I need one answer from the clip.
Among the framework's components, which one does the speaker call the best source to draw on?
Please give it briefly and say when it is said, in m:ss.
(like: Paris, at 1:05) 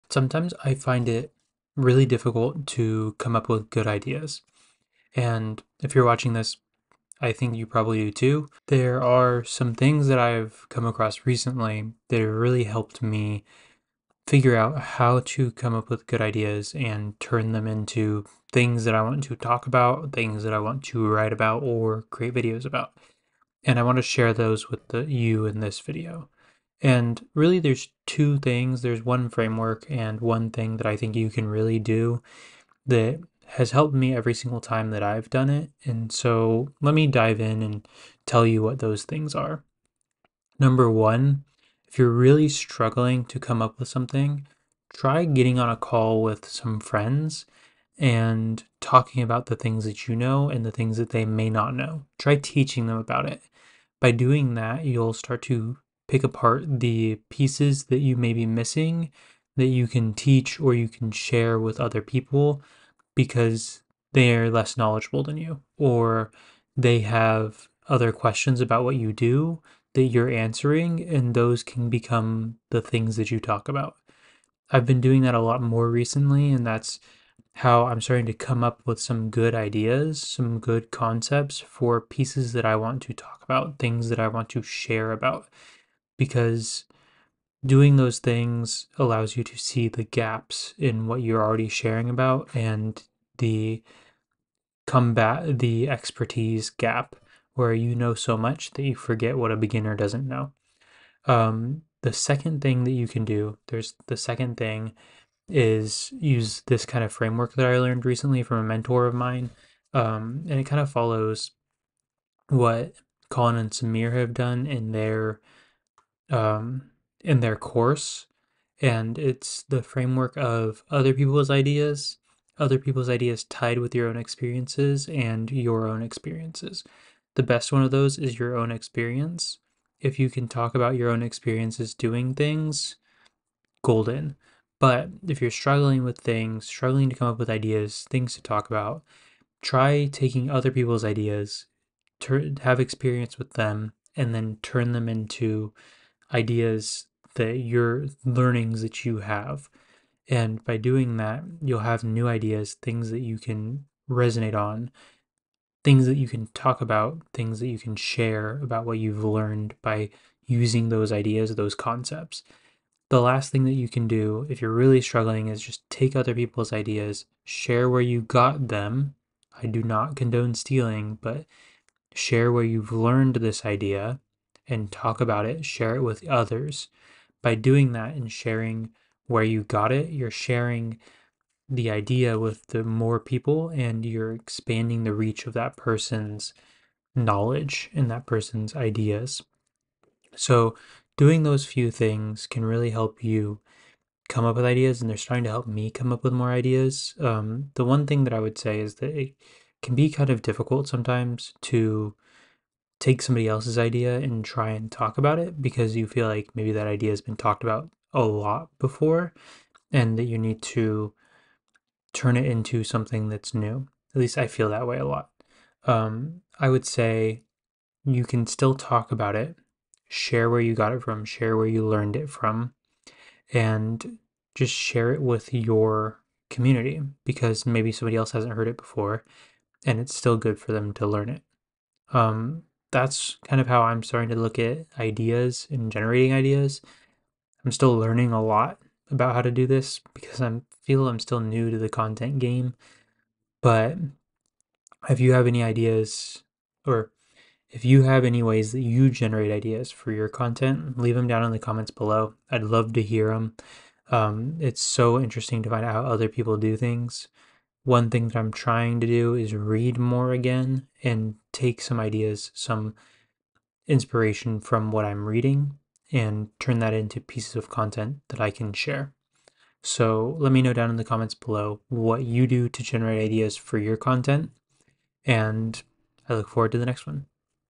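your own experience, at 2:08.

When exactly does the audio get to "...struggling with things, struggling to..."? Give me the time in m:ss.
2:15.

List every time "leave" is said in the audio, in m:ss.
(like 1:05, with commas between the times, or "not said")
4:10.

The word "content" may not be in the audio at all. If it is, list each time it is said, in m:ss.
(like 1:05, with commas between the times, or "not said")
4:01, 4:10, 4:27, 4:33.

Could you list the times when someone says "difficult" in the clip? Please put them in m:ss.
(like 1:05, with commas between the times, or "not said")
0:02, 3:20.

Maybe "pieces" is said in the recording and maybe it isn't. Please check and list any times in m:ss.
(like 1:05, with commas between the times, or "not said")
0:57, 1:22, 4:27.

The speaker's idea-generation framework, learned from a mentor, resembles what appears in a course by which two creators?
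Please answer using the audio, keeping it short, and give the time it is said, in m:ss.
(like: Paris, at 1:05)
Colin and Samir, at 1:53.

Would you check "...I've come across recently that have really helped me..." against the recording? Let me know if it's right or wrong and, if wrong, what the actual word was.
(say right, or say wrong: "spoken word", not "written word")
right.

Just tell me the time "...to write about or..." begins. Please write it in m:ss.
0:20.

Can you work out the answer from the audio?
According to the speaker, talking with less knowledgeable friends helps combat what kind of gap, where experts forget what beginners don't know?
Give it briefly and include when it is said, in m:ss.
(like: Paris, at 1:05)
the expertise gap, at 1:35.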